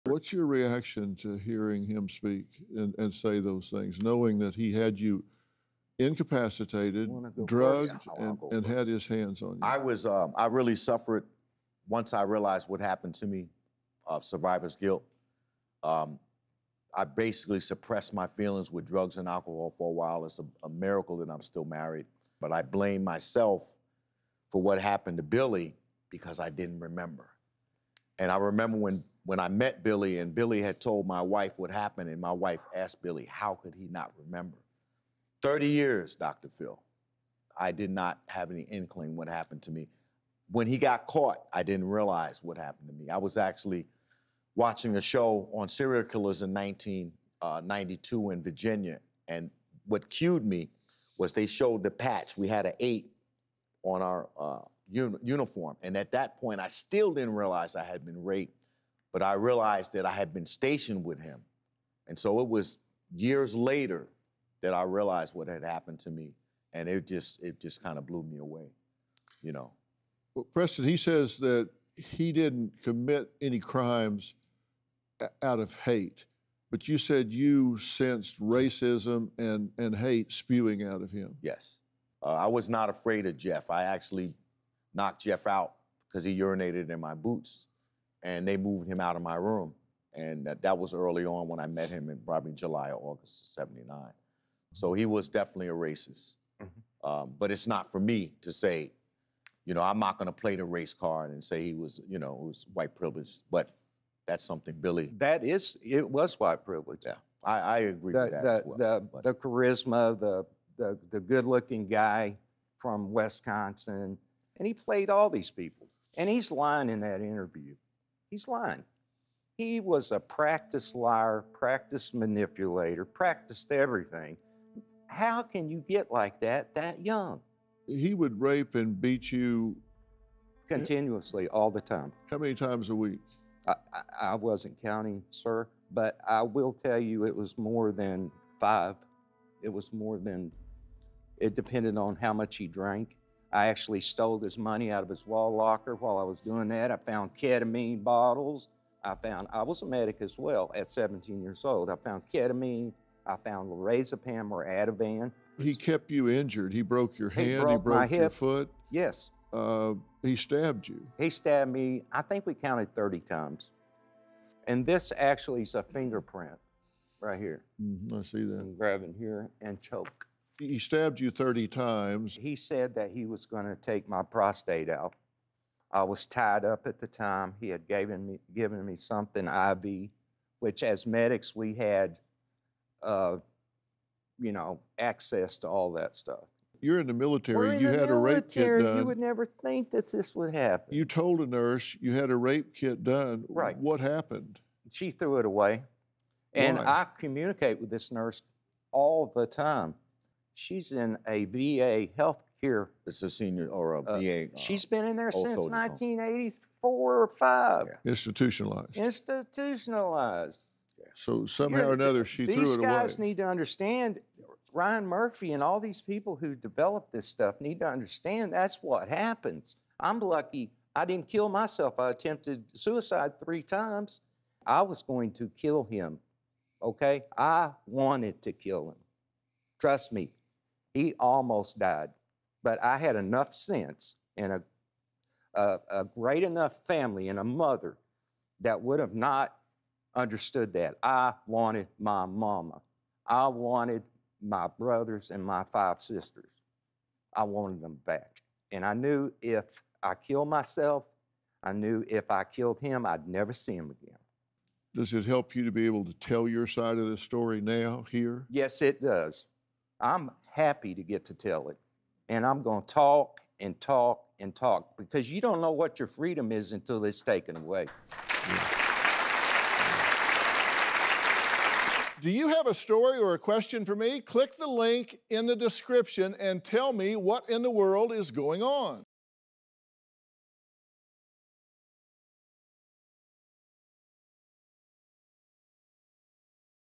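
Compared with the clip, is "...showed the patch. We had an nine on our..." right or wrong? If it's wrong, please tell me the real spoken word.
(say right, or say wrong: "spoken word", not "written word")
wrong: "eight", not "nine".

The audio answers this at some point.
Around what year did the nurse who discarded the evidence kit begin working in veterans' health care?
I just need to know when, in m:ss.
3:25.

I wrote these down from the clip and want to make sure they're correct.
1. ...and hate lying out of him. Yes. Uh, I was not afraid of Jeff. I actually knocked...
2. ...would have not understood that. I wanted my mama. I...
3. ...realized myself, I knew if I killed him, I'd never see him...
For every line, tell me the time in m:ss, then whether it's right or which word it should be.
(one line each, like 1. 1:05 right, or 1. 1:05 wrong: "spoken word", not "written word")
1. 1:19 wrong: "spewing", not "lying"
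2. 3:58 right
3. 4:10 wrong: "killed", not "realized".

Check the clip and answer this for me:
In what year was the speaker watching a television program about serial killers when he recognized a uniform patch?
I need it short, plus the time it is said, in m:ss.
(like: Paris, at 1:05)
1992, at 0:46.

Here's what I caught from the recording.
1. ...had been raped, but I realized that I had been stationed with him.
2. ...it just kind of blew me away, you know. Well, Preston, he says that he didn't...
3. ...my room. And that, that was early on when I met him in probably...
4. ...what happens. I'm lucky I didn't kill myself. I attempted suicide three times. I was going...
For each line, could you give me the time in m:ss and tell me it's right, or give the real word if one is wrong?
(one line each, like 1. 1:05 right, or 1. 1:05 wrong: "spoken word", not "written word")
1. 0:57 right
2. 1:07 right
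3. 1:29 right
4. 3:38 right.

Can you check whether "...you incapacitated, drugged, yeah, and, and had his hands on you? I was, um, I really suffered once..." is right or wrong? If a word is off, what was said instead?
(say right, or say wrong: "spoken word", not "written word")
right.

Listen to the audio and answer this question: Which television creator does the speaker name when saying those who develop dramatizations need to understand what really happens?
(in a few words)
Ryan Murphy.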